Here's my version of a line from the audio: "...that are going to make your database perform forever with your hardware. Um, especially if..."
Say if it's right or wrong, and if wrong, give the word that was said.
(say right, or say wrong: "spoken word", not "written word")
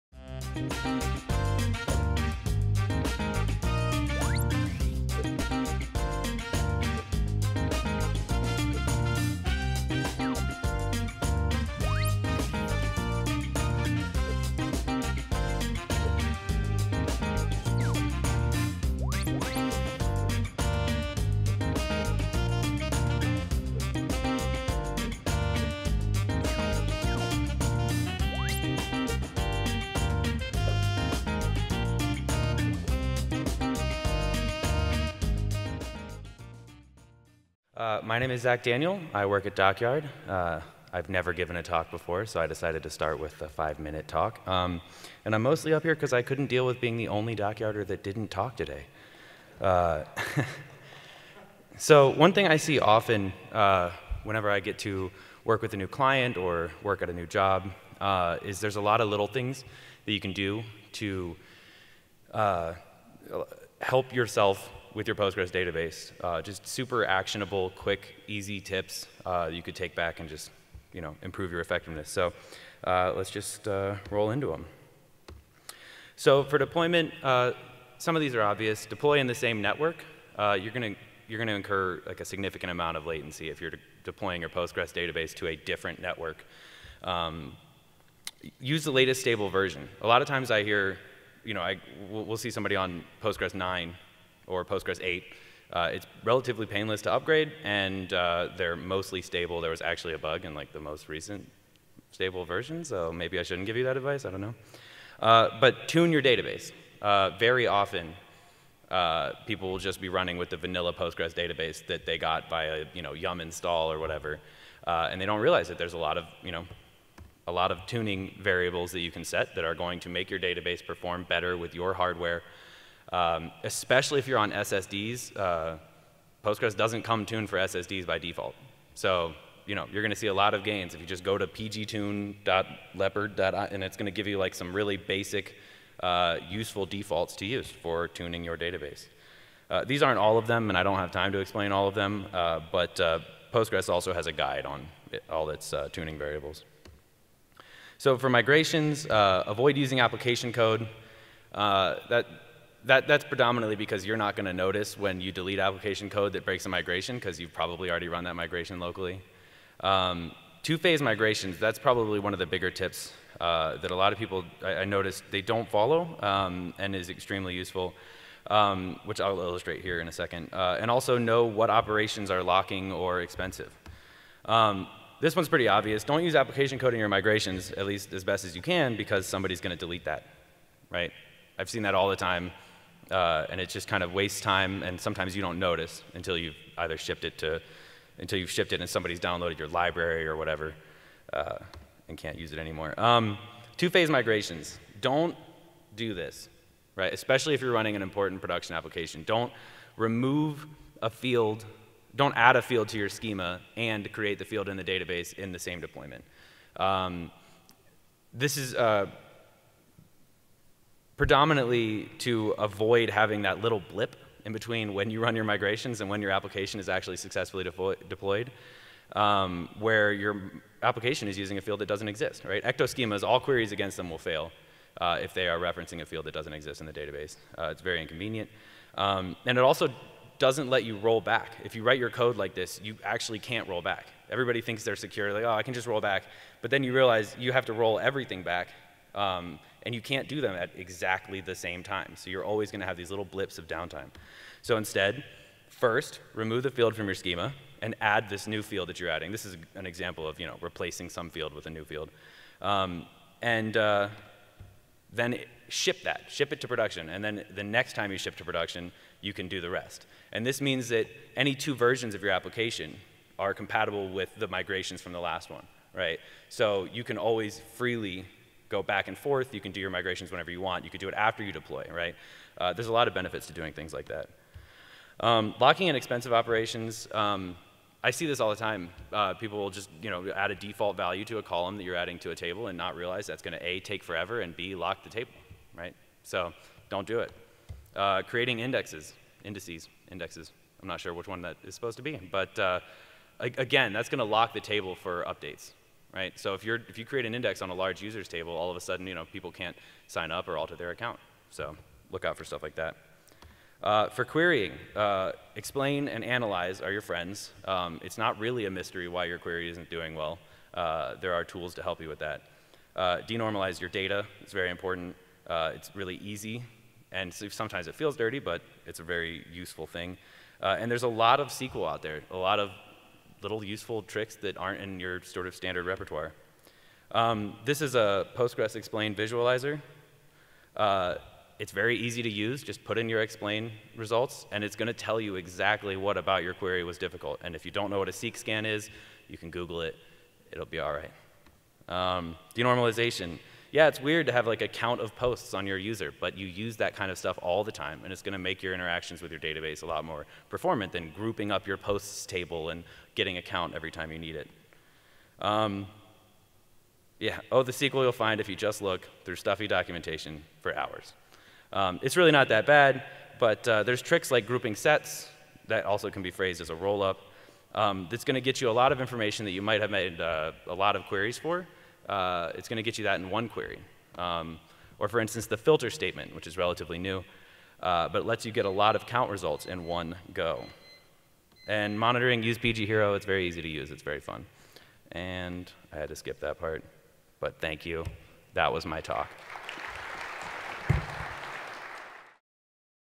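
wrong: "better", not "forever".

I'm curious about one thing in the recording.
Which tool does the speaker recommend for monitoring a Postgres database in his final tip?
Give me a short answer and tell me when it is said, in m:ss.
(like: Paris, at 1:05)
PgHero, at 6:22.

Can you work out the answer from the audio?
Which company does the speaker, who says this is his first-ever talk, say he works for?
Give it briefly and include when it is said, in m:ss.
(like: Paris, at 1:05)
DockYard, at 0:39.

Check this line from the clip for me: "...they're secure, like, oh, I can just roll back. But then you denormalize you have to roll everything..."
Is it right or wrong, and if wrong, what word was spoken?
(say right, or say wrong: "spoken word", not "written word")
wrong: "realize", not "denormalize".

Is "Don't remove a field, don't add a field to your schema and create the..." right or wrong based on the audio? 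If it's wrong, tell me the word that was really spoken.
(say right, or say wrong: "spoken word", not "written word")
right.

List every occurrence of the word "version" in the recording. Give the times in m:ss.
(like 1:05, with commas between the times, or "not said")
1:29, 1:42, 4:21.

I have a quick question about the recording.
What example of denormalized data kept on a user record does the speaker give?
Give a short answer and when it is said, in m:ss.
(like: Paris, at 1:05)
a count of posts, at 5:44.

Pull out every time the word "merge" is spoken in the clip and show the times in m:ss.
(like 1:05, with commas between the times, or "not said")
not said.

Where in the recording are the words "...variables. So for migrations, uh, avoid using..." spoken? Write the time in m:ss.
2:26.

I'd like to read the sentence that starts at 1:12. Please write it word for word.
So uh, let's just uh, roll into them.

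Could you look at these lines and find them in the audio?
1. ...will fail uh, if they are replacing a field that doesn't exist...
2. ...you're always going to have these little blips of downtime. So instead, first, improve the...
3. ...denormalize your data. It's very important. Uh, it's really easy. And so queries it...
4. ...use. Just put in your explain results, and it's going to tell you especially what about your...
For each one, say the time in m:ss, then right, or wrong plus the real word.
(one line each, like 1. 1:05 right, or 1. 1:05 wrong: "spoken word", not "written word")
1. 3:44 wrong: "referencing", not "replacing"
2. 4:02 wrong: "remove", not "improve"
3. 5:13 wrong: "sometimes", not "queries"
4. 5:32 wrong: "exactly", not "especially".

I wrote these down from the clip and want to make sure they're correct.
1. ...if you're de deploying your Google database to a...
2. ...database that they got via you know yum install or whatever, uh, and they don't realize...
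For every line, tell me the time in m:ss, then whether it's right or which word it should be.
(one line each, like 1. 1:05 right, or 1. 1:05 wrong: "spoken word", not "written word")
1. 1:23 wrong: "Postgres", not "Google"
2. 1:51 right.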